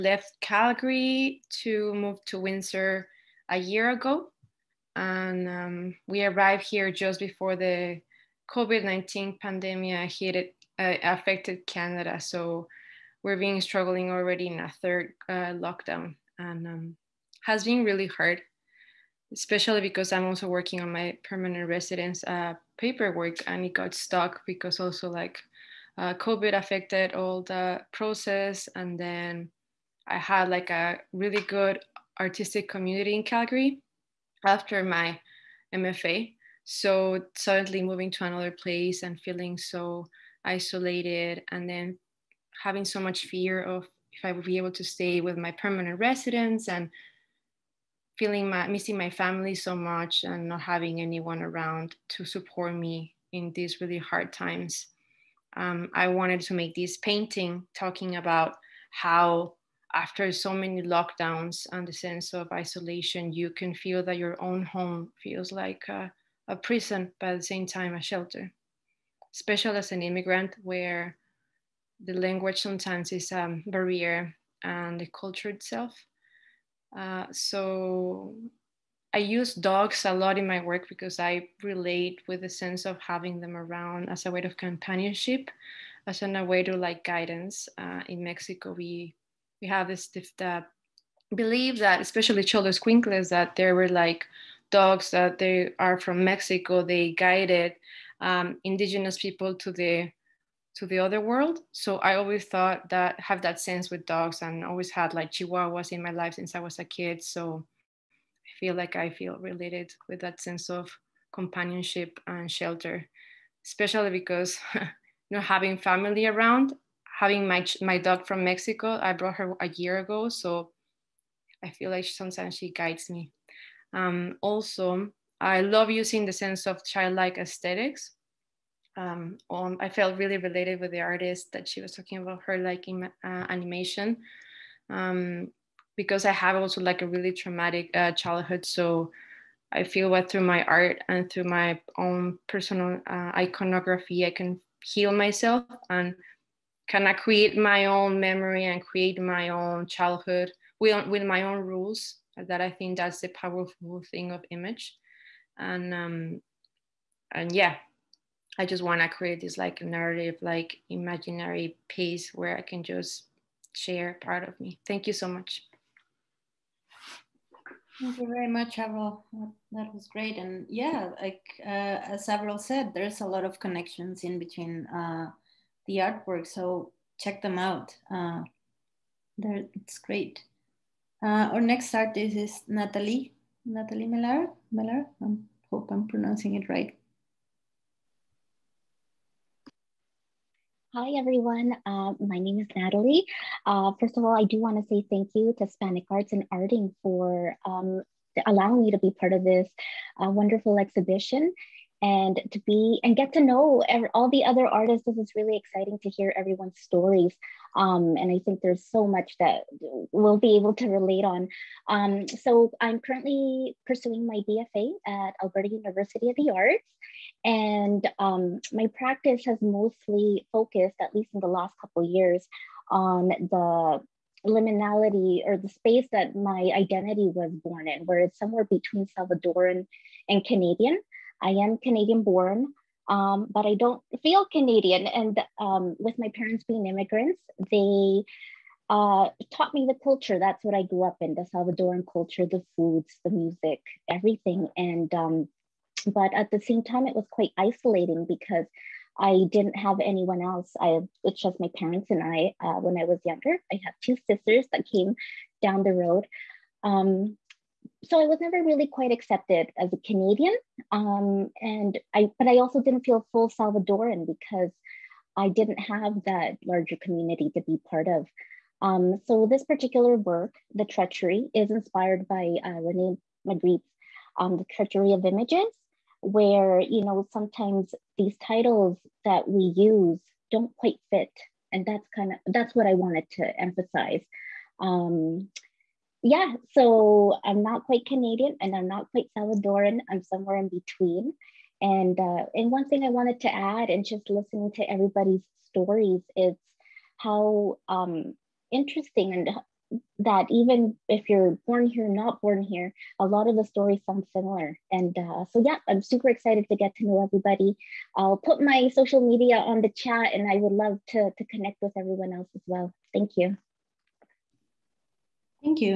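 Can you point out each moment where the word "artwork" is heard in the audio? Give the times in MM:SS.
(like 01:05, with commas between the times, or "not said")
02:55.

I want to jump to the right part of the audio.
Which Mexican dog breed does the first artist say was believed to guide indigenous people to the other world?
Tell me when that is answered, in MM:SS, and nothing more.
01:32.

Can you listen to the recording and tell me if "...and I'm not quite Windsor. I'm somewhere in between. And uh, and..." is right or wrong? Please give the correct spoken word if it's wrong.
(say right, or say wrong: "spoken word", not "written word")
wrong: "Salvadoran", not "Windsor".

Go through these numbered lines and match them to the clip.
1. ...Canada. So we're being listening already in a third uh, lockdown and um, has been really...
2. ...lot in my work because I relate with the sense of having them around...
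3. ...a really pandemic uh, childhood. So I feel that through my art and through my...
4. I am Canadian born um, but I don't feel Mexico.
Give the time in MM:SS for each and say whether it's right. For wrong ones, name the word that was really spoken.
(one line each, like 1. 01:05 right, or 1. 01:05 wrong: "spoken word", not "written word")
1. 00:11 wrong: "struggling", not "listening"
2. 01:20 right
3. 02:17 wrong: "traumatic", not "pandemic"
4. 03:51 wrong: "Canadian", not "Mexico".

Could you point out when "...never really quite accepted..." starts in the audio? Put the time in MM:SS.
04:18.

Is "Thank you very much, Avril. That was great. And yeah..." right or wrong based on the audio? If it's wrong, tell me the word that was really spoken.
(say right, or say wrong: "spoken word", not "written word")
right.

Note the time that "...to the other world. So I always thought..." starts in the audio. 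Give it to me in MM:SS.
01:40.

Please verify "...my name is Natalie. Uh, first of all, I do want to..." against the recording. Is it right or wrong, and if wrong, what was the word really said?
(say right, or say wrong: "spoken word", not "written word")
right.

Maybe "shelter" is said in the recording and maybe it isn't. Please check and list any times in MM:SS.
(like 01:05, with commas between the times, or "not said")
01:08, 01:52.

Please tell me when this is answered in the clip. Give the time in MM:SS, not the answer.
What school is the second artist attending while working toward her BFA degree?
03:35.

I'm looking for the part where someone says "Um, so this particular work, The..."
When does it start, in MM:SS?
04:28.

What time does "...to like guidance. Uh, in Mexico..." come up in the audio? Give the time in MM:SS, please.
01:26.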